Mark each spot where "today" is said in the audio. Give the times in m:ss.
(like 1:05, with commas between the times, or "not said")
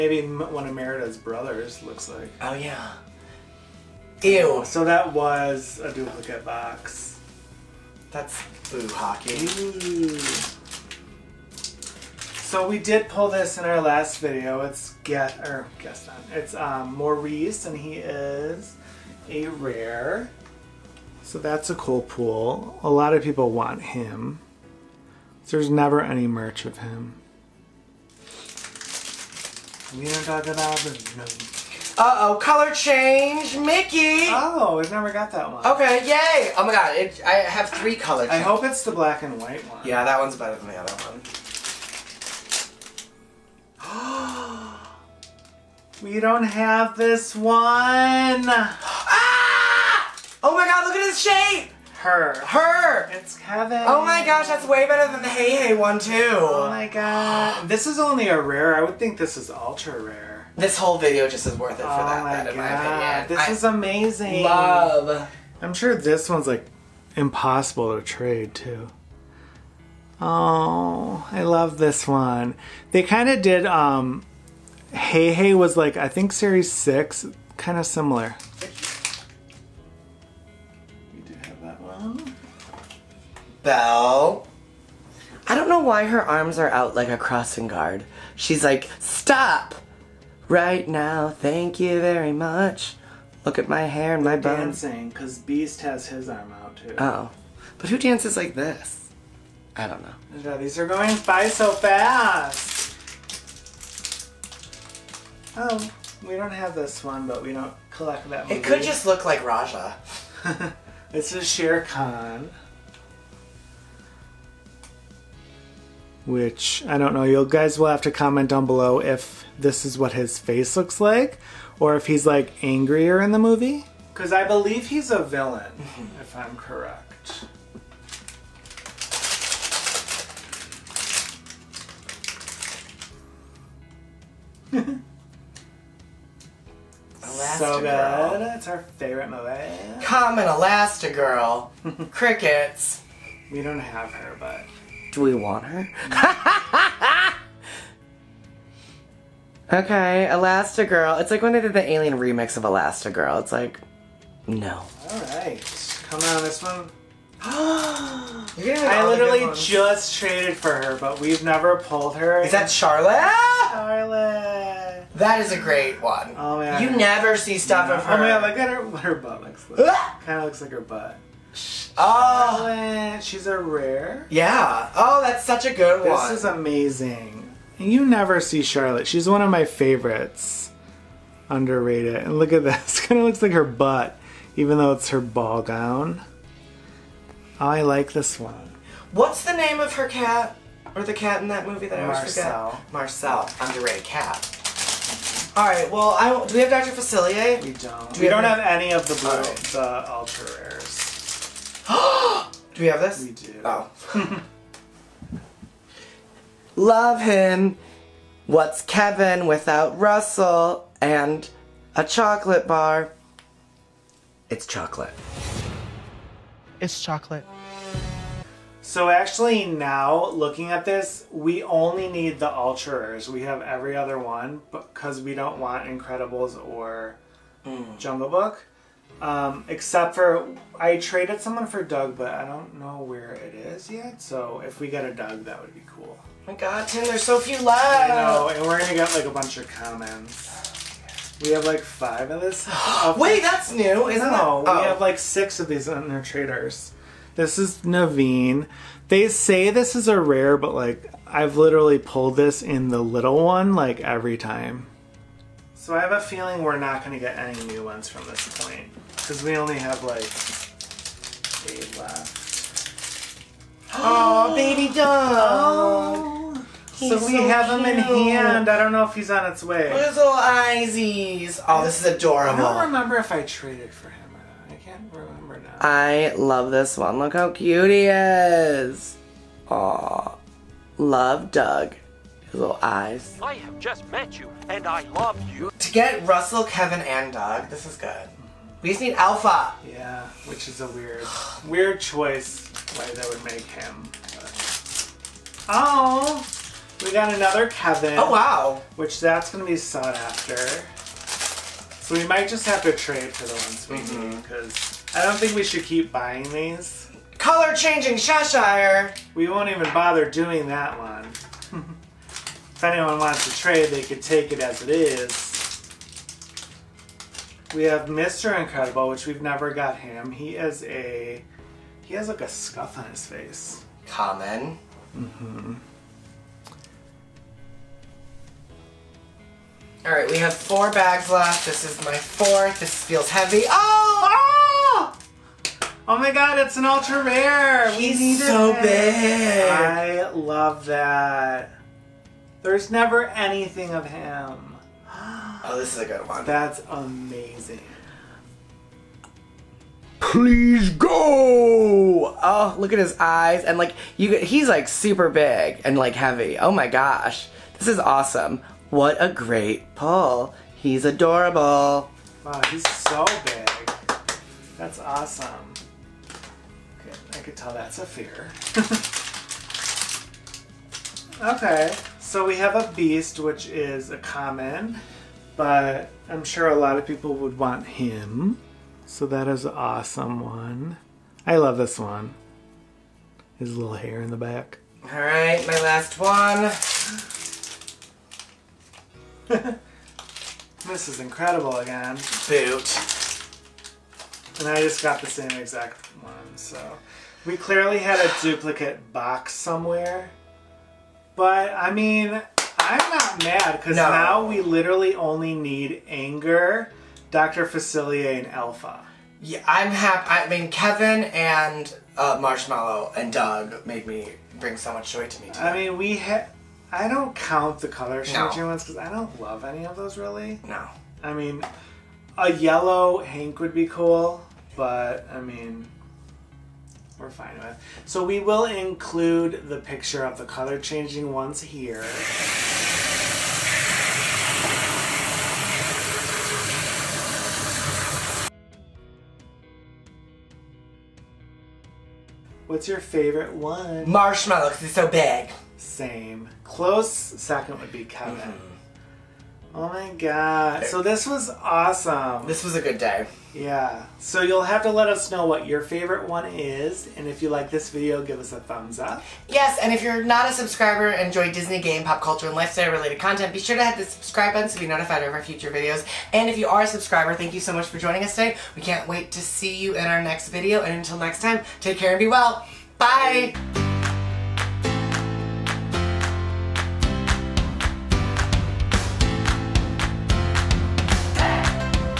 6:55, 7:48.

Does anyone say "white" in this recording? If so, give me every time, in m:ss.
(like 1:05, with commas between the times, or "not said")
0:39.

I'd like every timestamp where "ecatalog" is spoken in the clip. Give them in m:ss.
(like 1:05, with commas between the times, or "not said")
not said.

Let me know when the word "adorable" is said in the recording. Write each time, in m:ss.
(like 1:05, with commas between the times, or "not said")
4:32, 6:01.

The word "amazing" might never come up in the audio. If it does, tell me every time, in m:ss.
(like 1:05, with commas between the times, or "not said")
1:03, 2:56, 5:46.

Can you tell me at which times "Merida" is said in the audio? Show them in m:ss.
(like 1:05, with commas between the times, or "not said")
0:00.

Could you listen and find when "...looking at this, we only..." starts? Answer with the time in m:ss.
3:40.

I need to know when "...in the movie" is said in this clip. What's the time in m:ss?
2:03.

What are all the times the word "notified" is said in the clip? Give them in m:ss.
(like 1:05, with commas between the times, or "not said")
7:44.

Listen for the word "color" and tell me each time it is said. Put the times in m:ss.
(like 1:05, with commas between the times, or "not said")
0:32, 0:37, 5:07, 6:57, 7:10.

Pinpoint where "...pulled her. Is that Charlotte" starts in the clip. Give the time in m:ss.
2:41.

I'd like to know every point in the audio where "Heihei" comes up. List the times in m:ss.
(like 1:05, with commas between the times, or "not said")
0:55, 1:14.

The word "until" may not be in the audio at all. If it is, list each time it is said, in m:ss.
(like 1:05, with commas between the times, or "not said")
7:50.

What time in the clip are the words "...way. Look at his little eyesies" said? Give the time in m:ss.
4:29.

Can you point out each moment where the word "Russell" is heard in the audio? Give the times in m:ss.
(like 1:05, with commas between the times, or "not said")
3:29, 4:46.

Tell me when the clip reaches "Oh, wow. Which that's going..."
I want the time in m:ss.
4:58.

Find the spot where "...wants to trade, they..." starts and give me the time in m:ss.
5:13.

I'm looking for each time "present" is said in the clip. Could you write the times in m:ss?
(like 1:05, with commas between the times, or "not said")
not said.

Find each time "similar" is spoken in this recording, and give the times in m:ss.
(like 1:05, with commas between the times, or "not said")
1:17.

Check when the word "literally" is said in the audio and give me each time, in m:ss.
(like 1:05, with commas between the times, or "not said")
2:39, 4:11, 6:44.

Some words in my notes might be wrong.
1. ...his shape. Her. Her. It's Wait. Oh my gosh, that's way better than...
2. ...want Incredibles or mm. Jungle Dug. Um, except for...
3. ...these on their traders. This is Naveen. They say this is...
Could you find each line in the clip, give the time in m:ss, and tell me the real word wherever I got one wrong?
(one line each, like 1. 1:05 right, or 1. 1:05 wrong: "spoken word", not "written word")
1. 0:51 wrong: "Kevin", not "Wait"
2. 3:45 wrong: "Book", not "Dug"
3. 4:05 right.